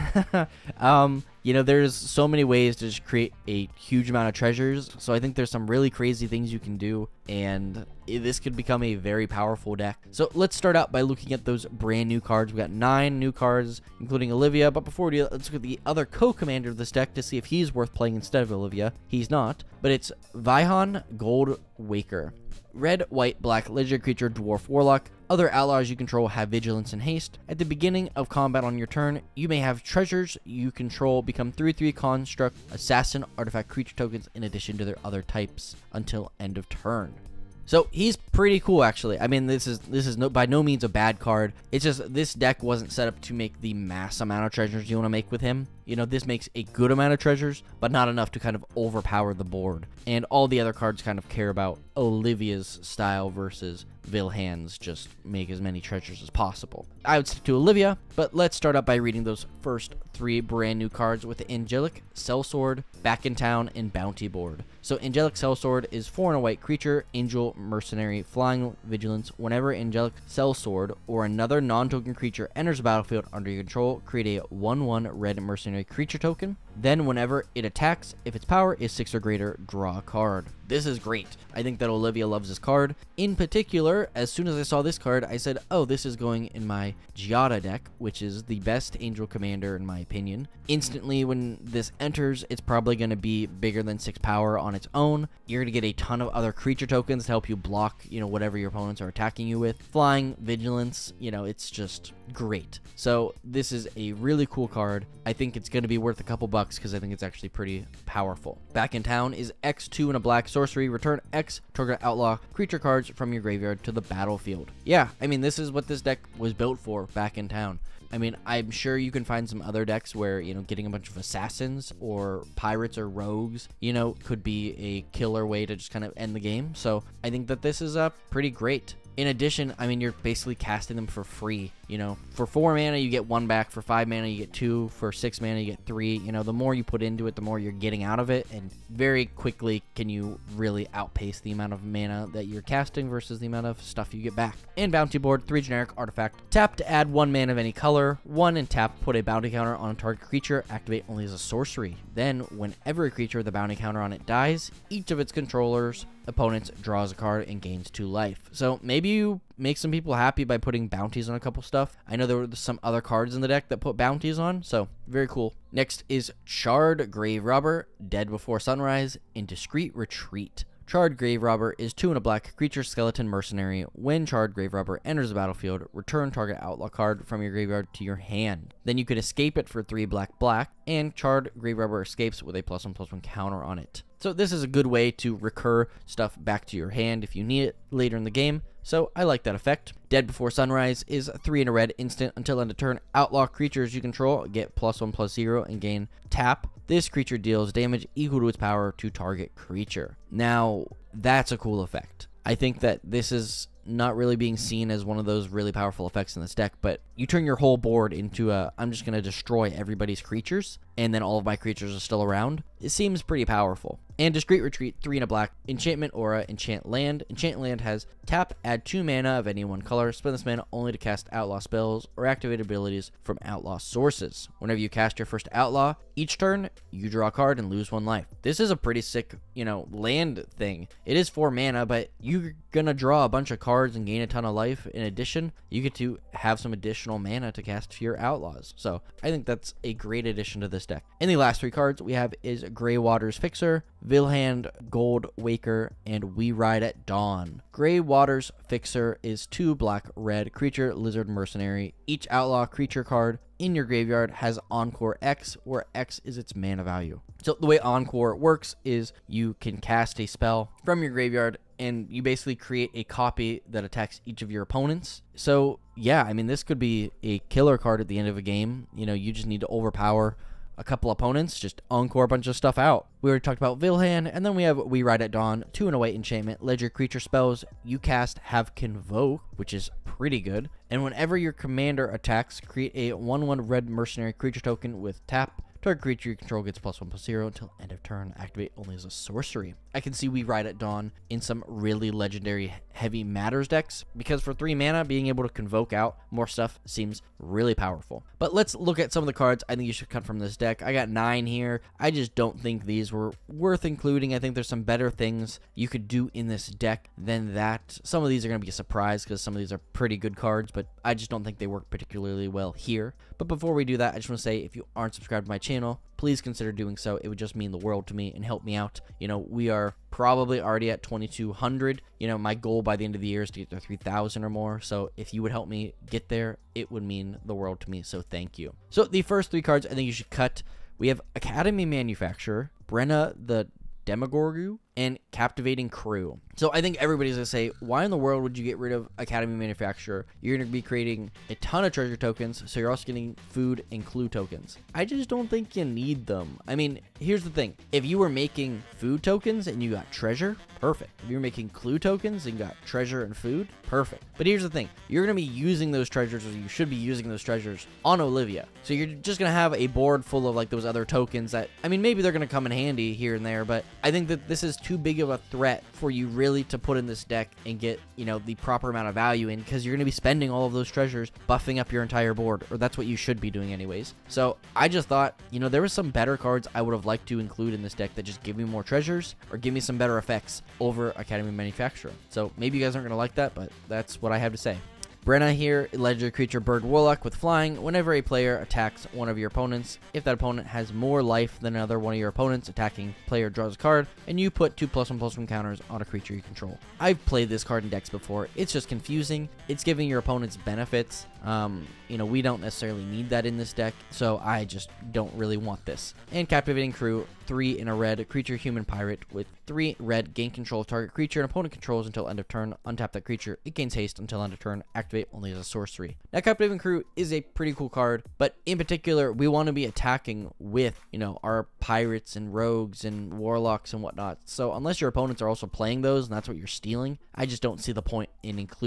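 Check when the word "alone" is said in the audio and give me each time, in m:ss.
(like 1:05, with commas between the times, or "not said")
not said.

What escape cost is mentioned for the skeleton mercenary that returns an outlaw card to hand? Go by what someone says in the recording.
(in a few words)
3 black black.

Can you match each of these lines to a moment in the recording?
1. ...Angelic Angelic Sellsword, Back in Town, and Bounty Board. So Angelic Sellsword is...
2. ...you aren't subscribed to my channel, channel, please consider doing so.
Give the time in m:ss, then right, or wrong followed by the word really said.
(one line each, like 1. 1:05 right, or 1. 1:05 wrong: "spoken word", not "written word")
1. 1:01 right
2. 5:14 right.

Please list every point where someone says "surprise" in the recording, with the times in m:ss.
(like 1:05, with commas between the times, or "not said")
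5:08.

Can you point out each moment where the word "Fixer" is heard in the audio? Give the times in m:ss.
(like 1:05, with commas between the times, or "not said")
4:03, 4:08.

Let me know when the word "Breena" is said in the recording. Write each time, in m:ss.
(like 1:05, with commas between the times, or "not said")
5:32, 6:25.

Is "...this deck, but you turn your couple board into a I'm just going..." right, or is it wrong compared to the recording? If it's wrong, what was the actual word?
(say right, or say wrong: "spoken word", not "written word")
wrong: "whole", not "couple".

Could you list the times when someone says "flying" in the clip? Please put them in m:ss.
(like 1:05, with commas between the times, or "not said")
1:08, 1:39, 6:27.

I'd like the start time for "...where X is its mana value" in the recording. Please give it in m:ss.
4:15.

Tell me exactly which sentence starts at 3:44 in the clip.
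Whenever you cast your first outlaw, each turn, you draw a card and lose one life.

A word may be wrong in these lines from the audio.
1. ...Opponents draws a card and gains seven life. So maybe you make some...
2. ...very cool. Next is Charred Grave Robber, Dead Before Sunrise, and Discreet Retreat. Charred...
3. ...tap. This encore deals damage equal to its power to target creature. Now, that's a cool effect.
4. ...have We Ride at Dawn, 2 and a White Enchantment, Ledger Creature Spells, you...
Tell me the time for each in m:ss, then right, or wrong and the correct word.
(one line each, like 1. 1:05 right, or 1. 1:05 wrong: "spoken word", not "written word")
1. 2:36 wrong: "two", not "seven"
2. 2:45 right
3. 3:16 wrong: "creature", not "encore"
4. 4:34 right.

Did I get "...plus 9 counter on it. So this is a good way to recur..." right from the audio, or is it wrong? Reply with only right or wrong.
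wrong.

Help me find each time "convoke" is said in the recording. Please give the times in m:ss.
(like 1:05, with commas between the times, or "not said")
4:38, 4:55.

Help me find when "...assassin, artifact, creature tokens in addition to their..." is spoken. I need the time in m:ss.
0:32.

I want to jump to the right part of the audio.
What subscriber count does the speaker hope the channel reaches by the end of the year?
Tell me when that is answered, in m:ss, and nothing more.
5:23.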